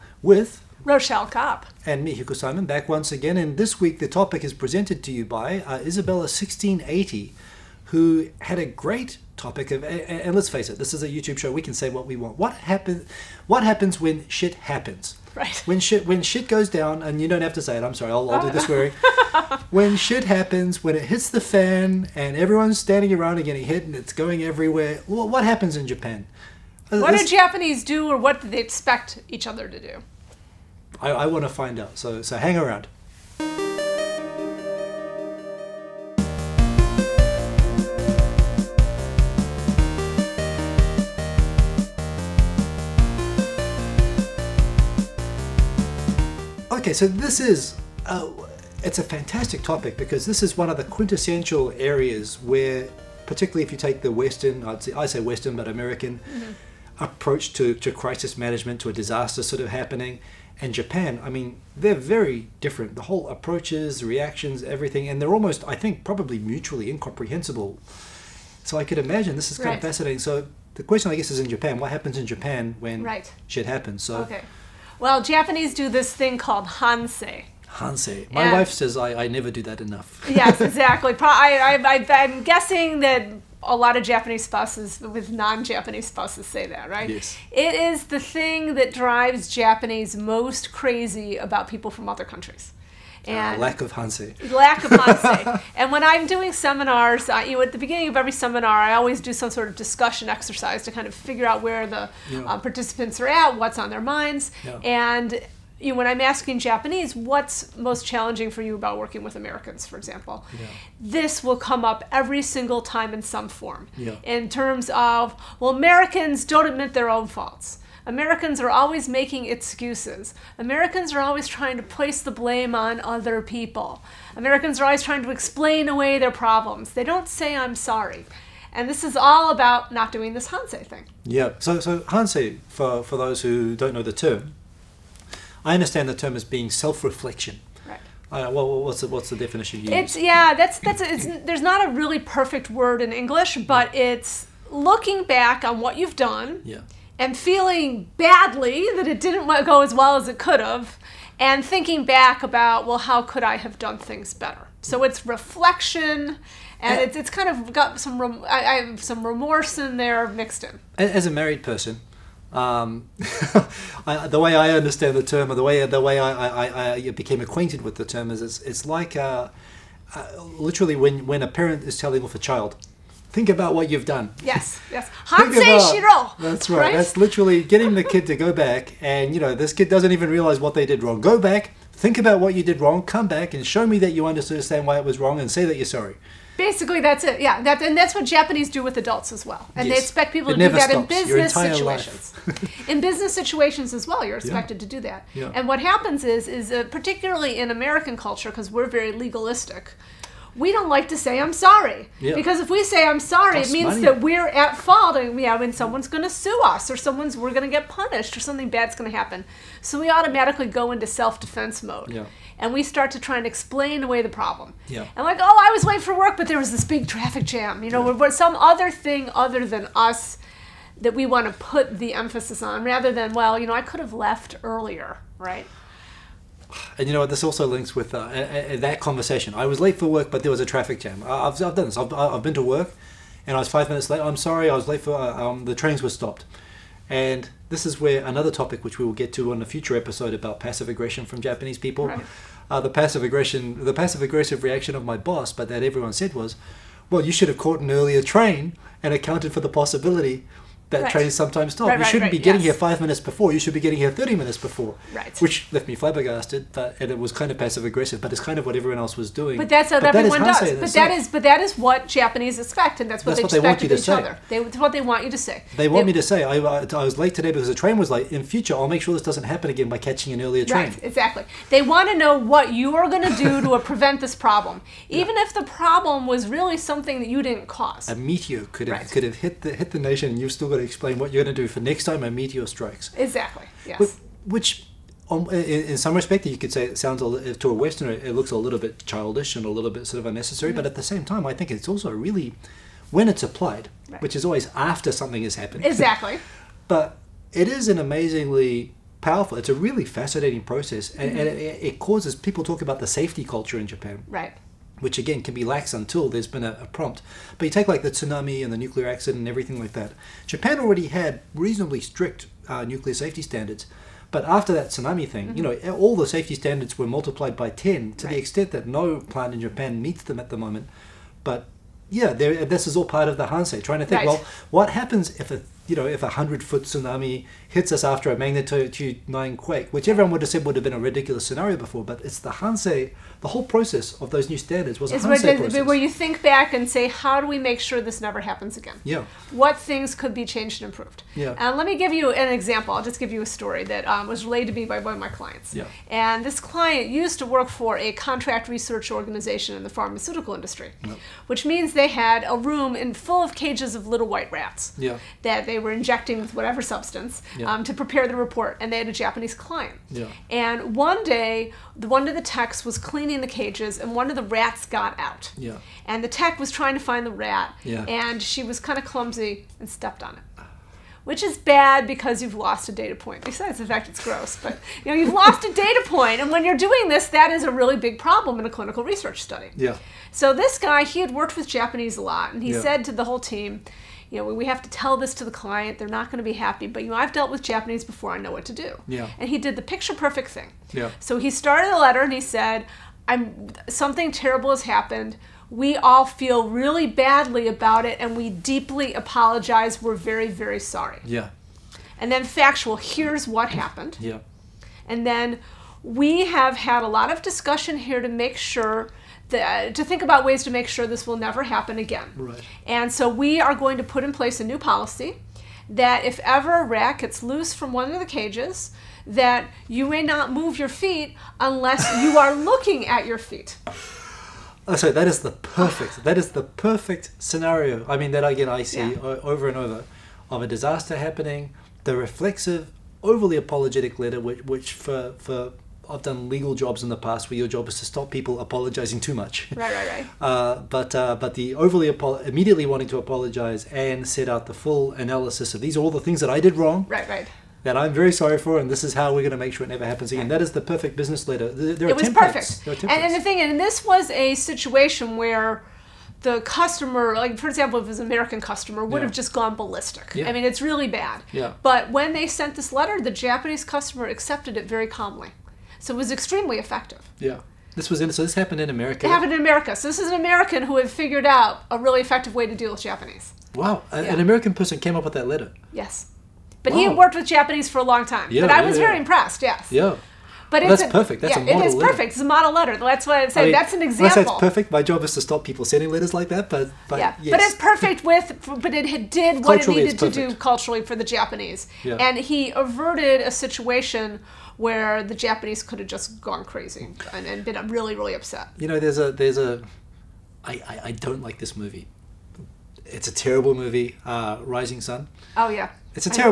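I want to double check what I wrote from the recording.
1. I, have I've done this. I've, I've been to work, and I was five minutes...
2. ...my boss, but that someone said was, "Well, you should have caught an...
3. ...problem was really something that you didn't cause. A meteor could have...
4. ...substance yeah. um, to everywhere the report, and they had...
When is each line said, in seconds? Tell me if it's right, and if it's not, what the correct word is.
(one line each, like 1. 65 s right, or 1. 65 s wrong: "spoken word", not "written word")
1. 231 s right
2. 245 s wrong: "everyone", not "someone"
3. 275 s right
4. 356 s wrong: "prepare", not "everywhere".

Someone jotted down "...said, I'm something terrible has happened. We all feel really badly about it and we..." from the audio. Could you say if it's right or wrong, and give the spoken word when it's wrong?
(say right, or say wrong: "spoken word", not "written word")
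right.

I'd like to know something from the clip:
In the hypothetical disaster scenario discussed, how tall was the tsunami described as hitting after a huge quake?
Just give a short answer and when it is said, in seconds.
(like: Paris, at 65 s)
100 foot, at 326 s.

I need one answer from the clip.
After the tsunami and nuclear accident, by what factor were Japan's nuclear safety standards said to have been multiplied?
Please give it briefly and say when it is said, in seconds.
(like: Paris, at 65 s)
10, at 317 s.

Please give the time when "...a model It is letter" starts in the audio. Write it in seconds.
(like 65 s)
481 s.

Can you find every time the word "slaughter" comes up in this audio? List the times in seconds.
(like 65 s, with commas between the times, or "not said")
not said.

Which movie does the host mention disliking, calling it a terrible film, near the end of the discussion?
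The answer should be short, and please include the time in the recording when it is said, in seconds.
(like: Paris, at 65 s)
Rising Sun, at 504 s.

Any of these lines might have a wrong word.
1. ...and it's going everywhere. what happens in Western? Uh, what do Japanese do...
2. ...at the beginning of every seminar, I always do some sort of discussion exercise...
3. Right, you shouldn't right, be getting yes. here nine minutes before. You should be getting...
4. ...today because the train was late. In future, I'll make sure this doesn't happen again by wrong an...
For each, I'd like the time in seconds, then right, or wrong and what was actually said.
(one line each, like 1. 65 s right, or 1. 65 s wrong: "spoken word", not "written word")
1. 23 s wrong: "Japan", not "Western"
2. 97 s right
3. 251 s wrong: "five", not "nine"
4. 267 s wrong: "catching", not "wrong".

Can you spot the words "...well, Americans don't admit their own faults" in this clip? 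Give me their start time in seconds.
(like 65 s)
115 s.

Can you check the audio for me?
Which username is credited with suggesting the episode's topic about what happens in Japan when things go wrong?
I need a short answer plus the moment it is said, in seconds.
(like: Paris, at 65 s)
Isabella 1680, at 5 s.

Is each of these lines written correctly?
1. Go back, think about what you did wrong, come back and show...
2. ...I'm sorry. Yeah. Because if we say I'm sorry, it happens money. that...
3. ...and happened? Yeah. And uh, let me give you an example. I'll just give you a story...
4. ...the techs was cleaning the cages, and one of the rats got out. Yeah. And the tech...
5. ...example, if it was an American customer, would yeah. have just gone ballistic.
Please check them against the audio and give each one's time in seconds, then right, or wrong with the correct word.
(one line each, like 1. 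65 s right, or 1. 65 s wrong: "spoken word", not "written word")
1. 181 s right
2. 201 s wrong: "means", not "happens"
3. 340 s wrong: "improved", not "happened"
4. 362 s right
5. 457 s right.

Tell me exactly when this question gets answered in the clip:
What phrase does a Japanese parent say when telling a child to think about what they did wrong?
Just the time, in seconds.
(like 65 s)
175 s.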